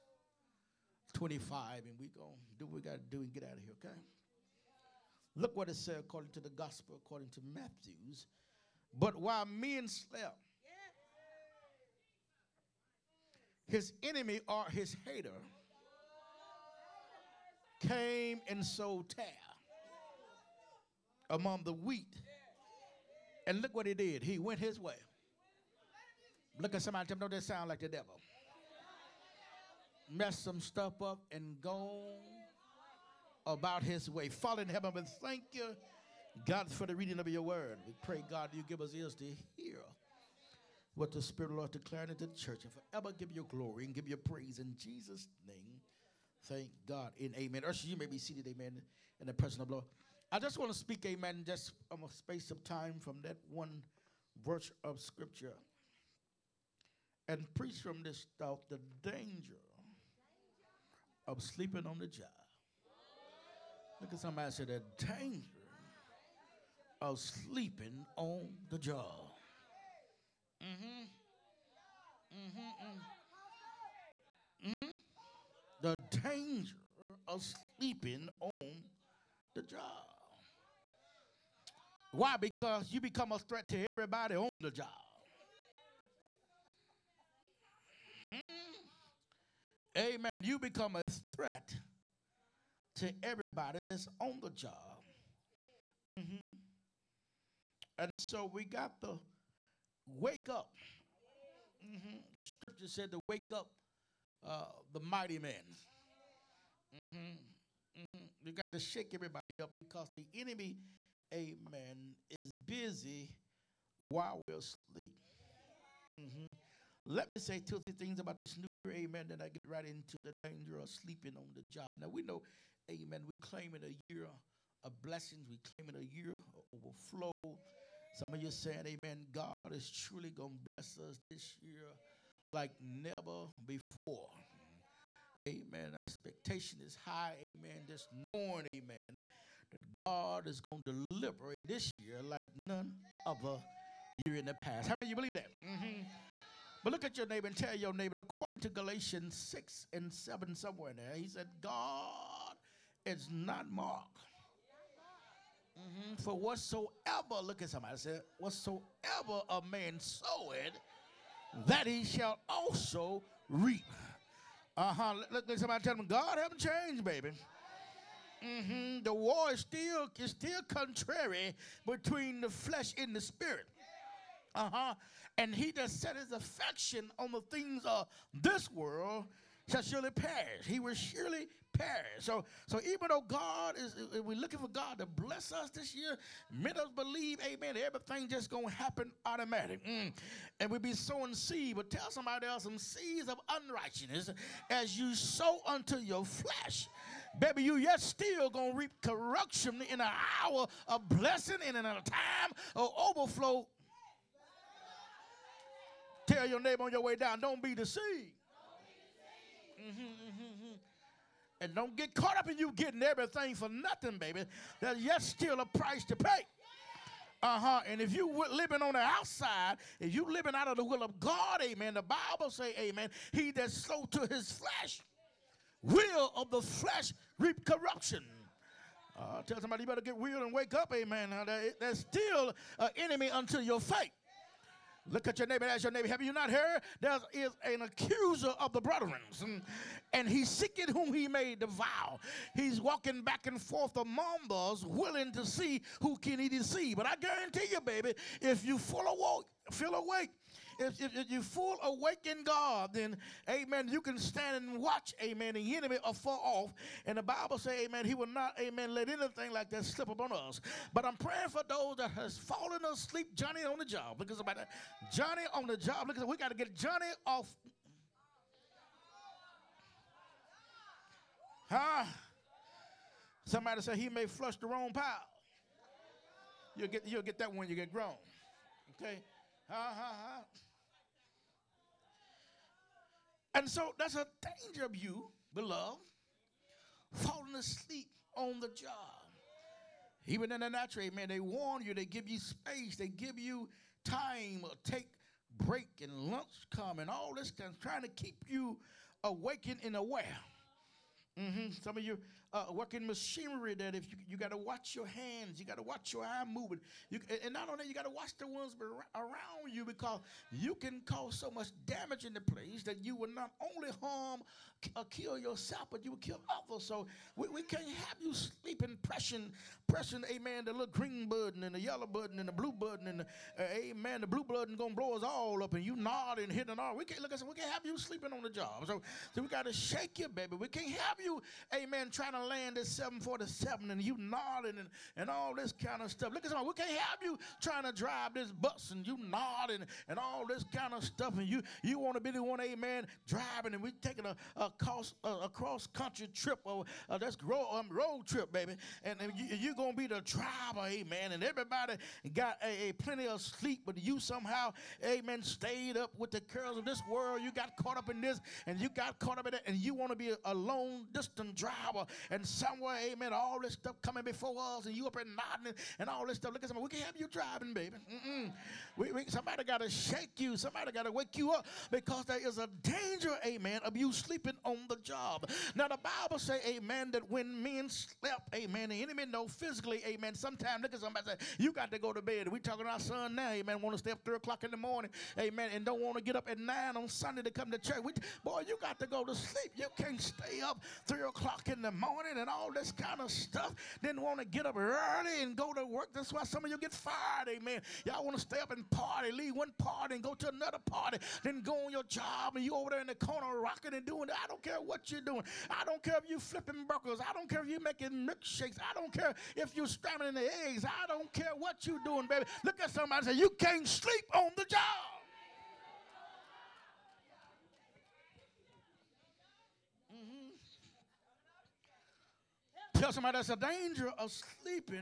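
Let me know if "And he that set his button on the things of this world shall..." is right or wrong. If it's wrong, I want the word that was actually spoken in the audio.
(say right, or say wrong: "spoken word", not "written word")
wrong: "affection", not "button".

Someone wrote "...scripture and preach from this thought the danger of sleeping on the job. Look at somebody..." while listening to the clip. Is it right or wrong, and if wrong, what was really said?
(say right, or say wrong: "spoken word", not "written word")
right.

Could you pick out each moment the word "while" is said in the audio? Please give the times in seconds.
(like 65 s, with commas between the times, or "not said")
9 s, 113 s.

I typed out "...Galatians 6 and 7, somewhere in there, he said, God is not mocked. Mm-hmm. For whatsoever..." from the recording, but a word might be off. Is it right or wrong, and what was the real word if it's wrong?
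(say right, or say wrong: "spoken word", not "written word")
right.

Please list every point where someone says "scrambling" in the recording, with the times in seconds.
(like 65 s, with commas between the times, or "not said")
409 s.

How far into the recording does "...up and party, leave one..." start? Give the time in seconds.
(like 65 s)
398 s.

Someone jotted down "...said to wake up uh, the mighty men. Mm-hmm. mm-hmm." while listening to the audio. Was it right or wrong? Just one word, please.
right.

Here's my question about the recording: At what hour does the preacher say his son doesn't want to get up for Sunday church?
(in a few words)
9.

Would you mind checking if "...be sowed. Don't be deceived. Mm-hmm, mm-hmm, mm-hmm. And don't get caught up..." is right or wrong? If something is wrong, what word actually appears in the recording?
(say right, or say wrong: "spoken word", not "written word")
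wrong: "deceived", not "sowed".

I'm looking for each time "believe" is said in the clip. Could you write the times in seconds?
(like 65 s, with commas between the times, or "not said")
145 s, 186 s.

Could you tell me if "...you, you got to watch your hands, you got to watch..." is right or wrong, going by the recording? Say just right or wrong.
right.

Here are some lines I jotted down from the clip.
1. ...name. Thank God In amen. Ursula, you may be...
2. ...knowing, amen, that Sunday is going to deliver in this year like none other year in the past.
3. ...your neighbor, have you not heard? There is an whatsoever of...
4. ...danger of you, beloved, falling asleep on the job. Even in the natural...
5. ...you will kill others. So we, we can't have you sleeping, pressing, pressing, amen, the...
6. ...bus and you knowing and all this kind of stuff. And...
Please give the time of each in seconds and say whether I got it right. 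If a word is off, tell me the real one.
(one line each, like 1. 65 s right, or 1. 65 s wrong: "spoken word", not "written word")
1. 45 s right
2. 138 s wrong: "God", not "Sunday"
3. 235 s wrong: "accuser", not "whatsoever"
4. 284 s right
5. 316 s right
6. 338 s wrong: "nodding", not "knowing".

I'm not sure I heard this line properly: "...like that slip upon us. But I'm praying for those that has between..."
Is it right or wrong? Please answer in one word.
wrong.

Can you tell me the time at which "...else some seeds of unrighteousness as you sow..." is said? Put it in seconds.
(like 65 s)
192 s.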